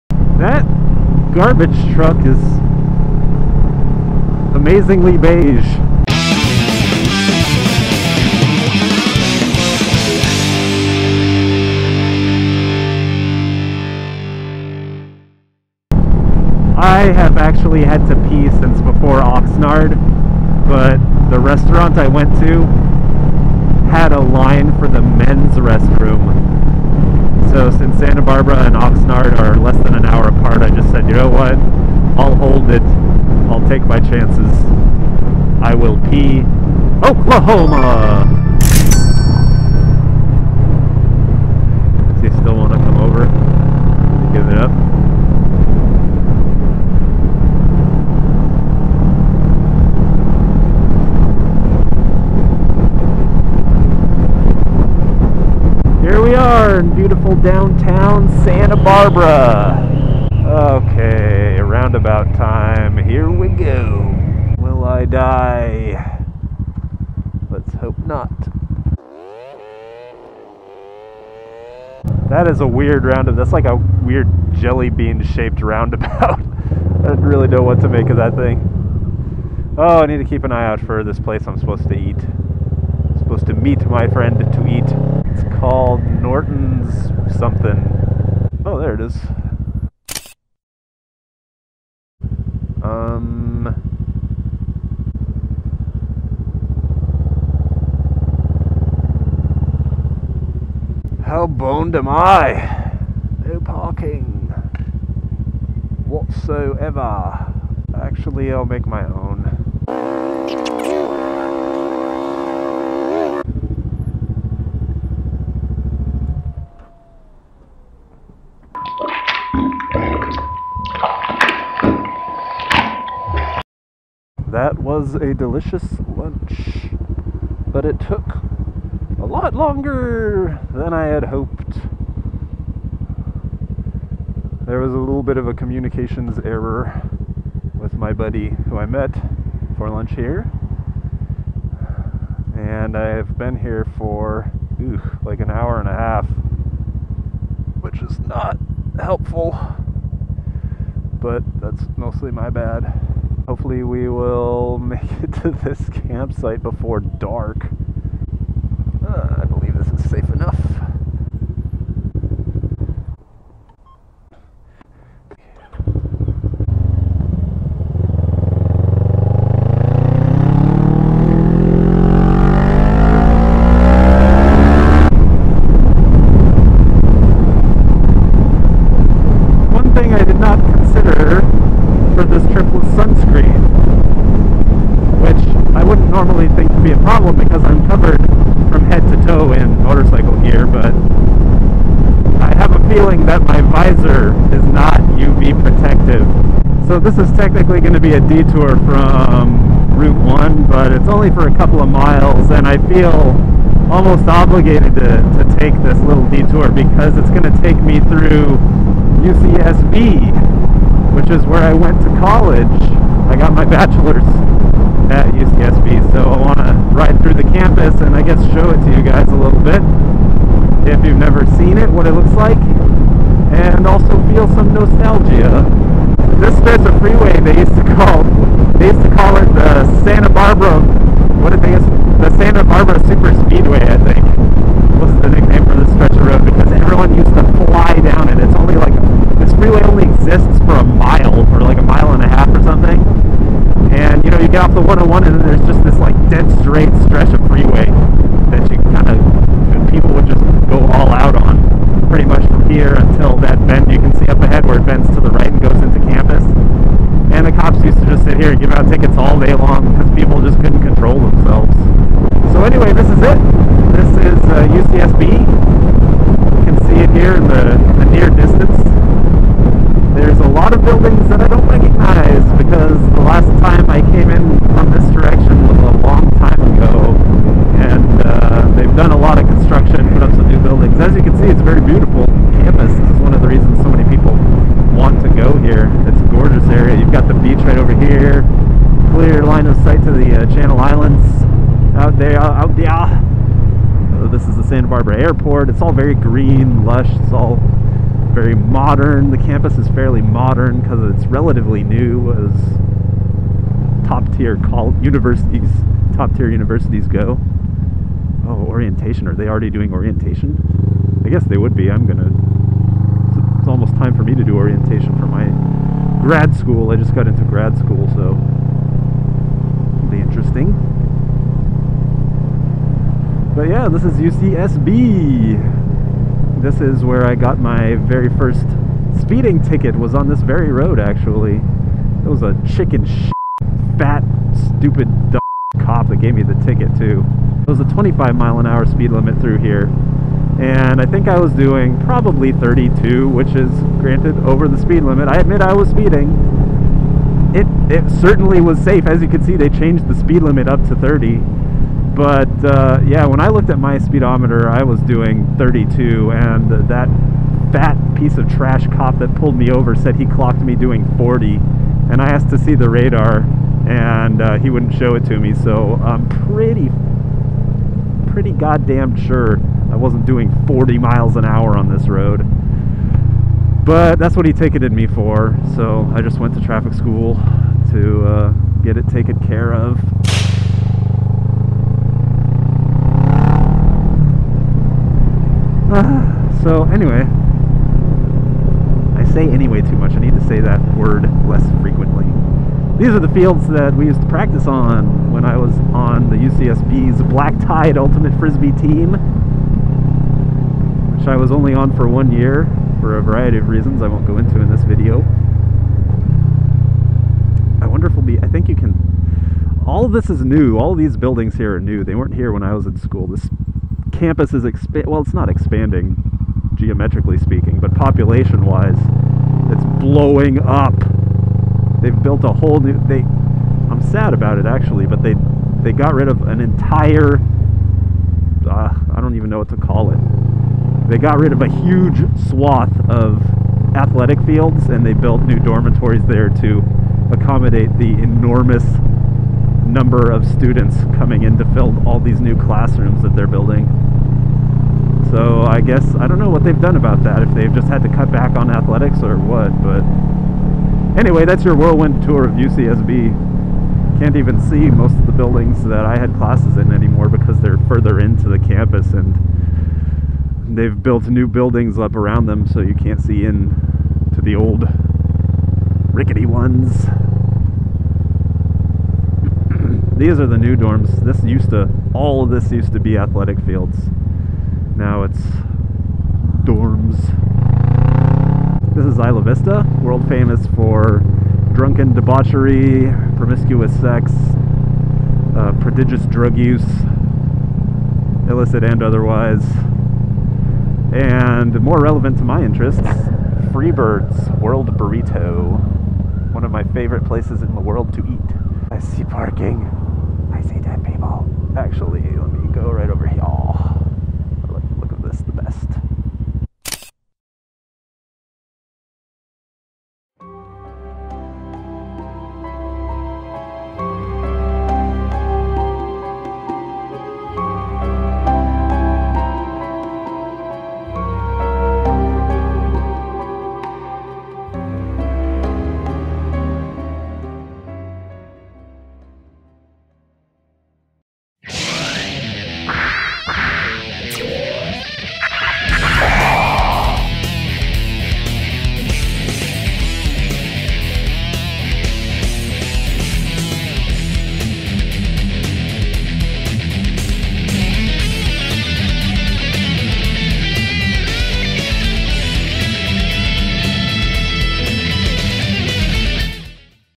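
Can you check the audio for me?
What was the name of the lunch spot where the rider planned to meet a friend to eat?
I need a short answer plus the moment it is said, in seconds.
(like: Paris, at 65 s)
Norton's, at 86 s.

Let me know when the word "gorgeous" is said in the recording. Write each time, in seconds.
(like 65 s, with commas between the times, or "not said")
286 s.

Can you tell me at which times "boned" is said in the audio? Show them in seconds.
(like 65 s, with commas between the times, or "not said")
101 s.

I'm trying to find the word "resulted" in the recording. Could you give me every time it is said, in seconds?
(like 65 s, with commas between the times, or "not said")
not said.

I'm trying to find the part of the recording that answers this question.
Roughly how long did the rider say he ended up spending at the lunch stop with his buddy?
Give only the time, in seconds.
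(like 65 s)
145 s.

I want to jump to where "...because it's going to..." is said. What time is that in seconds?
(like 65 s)
206 s.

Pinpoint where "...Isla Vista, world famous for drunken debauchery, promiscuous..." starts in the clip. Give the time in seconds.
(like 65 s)
479 s.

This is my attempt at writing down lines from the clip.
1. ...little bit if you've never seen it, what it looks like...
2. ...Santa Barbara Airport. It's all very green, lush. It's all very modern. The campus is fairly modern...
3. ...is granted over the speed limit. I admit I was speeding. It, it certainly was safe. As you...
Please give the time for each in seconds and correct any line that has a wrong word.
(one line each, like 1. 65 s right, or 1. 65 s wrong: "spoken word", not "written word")
1. 219 s right
2. 294 s right
3. 343 s right.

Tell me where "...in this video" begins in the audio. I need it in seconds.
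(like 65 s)
404 s.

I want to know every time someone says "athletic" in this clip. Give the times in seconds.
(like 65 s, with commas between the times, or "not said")
433 s, 448 s, 473 s.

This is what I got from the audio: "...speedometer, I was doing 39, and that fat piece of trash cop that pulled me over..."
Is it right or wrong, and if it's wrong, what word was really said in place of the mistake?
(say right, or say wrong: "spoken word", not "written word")
wrong: "32", not "39".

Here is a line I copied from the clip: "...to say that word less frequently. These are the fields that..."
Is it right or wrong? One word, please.
right.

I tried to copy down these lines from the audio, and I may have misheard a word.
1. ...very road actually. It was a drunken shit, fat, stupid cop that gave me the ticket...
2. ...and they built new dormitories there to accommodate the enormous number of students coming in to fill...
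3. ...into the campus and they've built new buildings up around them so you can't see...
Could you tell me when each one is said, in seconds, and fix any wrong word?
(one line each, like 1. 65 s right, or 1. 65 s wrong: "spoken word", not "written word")
1. 330 s wrong: "chicken", not "drunken"
2. 434 s right
3. 458 s right.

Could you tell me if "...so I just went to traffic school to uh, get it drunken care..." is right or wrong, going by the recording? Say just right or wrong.
wrong.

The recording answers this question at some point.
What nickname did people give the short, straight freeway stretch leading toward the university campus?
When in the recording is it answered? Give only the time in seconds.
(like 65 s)
232 s.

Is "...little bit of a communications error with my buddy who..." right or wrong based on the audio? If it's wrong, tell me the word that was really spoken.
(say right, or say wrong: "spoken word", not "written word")
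right.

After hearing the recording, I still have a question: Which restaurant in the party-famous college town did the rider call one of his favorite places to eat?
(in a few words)
Freebird's World Burrito.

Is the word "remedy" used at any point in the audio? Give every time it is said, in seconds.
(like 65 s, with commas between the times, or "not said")
not said.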